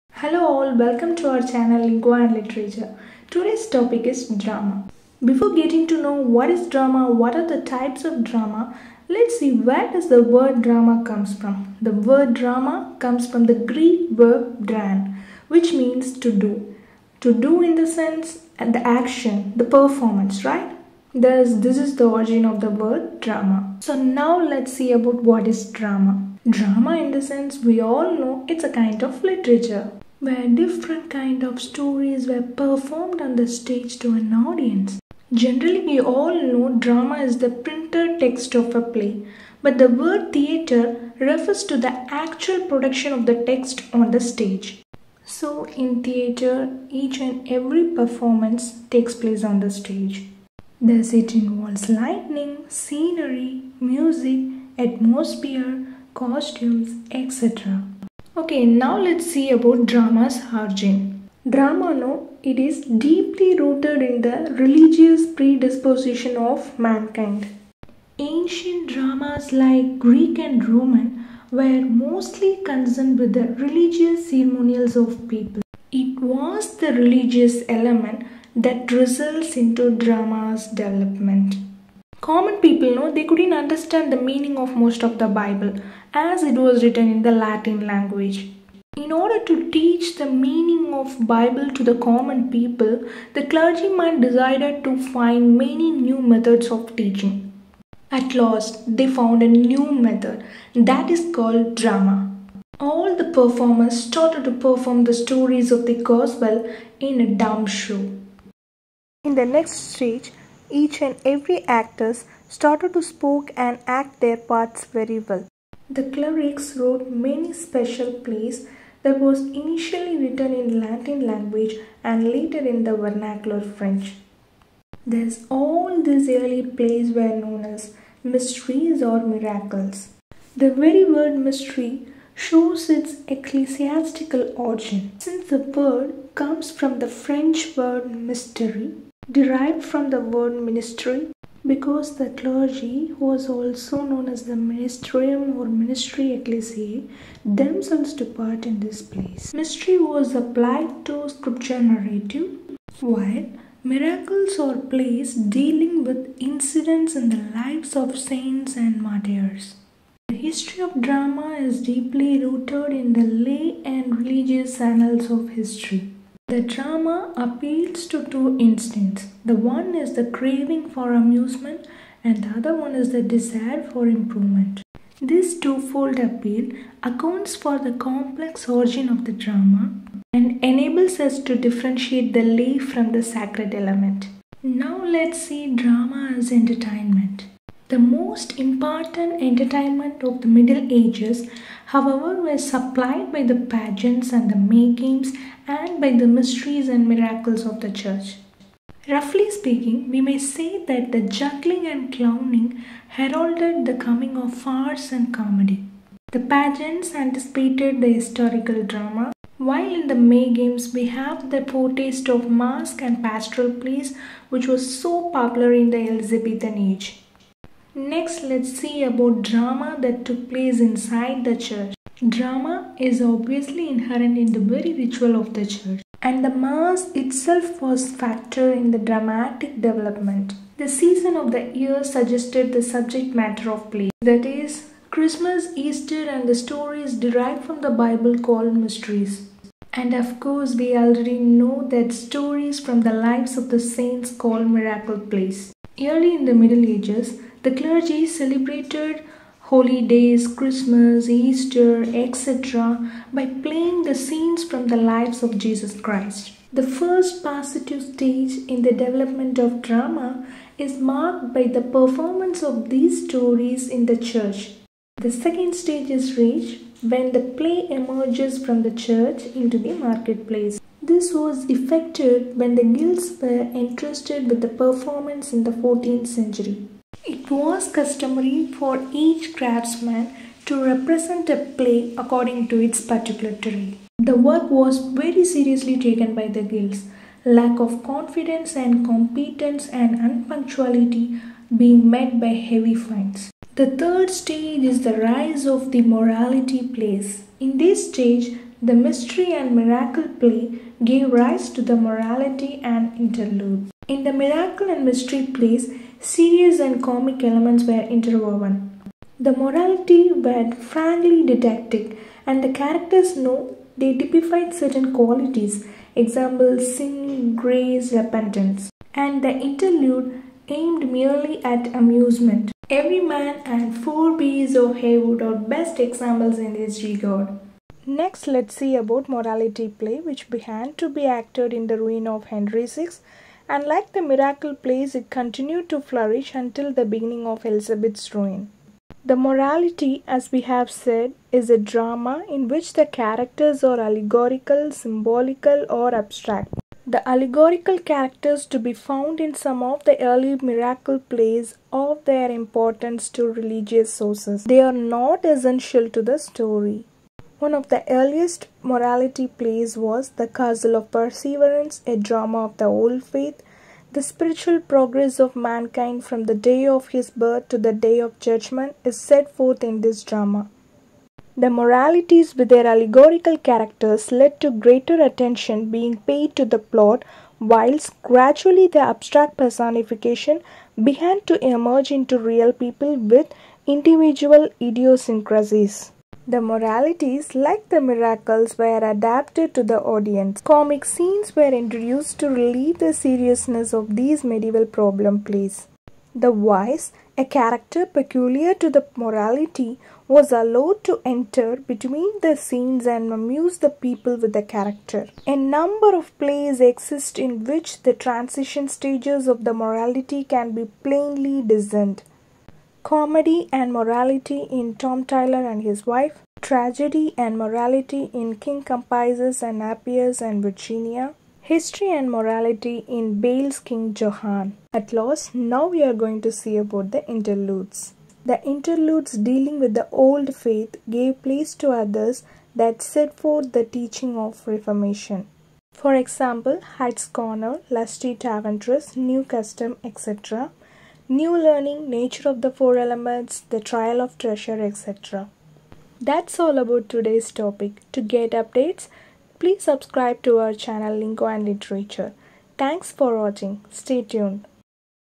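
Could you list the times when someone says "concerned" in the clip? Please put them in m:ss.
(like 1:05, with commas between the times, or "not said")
1:12.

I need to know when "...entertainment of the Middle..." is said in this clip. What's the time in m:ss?
3:09.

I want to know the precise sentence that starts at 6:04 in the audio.
The spiritual progress of mankind from the day of his birth to the day of judgment is set forth in this drama.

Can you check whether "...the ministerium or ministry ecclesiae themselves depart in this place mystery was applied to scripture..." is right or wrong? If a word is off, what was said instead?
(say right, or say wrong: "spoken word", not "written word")
right.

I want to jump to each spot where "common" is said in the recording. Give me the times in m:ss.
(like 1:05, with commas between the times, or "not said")
1:22, 1:31.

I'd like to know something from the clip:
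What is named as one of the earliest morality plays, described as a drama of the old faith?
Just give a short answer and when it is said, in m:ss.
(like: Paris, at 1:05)
The Castle of Perseverance, at 6:00.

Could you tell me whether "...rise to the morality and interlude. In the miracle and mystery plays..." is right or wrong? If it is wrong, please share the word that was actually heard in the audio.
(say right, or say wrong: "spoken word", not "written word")
right.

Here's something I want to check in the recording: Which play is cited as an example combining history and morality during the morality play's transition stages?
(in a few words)
King Johan.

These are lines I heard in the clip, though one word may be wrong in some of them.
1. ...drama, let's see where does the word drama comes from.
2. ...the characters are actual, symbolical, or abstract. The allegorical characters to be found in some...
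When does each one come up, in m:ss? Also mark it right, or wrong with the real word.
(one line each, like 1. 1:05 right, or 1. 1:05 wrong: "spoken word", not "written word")
1. 0:08 right
2. 5:42 wrong: "allegorical", not "actual".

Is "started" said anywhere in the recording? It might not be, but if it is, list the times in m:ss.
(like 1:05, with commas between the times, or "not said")
1:44, 1:52.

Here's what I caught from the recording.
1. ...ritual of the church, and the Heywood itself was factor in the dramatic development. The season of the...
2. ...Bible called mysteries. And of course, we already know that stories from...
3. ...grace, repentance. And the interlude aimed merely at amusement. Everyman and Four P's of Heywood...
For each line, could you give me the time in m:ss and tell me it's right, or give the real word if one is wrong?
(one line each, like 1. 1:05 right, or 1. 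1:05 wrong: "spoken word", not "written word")
1. 3:44 wrong: "Mass", not "Heywood"
2. 3:57 right
3. 5:17 right.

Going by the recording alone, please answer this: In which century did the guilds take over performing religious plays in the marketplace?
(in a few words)
14th century.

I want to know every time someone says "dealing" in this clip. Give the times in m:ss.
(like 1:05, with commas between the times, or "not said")
2:35, 7:09.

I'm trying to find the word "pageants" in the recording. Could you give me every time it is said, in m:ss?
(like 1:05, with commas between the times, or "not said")
3:13, 3:26.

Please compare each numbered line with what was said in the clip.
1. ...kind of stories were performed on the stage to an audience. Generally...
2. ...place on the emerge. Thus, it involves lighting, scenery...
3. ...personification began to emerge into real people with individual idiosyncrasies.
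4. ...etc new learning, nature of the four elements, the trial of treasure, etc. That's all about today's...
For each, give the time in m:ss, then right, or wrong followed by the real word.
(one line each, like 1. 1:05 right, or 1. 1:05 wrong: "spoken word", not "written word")
1. 0:31 right
2. 0:49 wrong: "stage", not "emerge"
3. 6:19 right
4. 7:20 right.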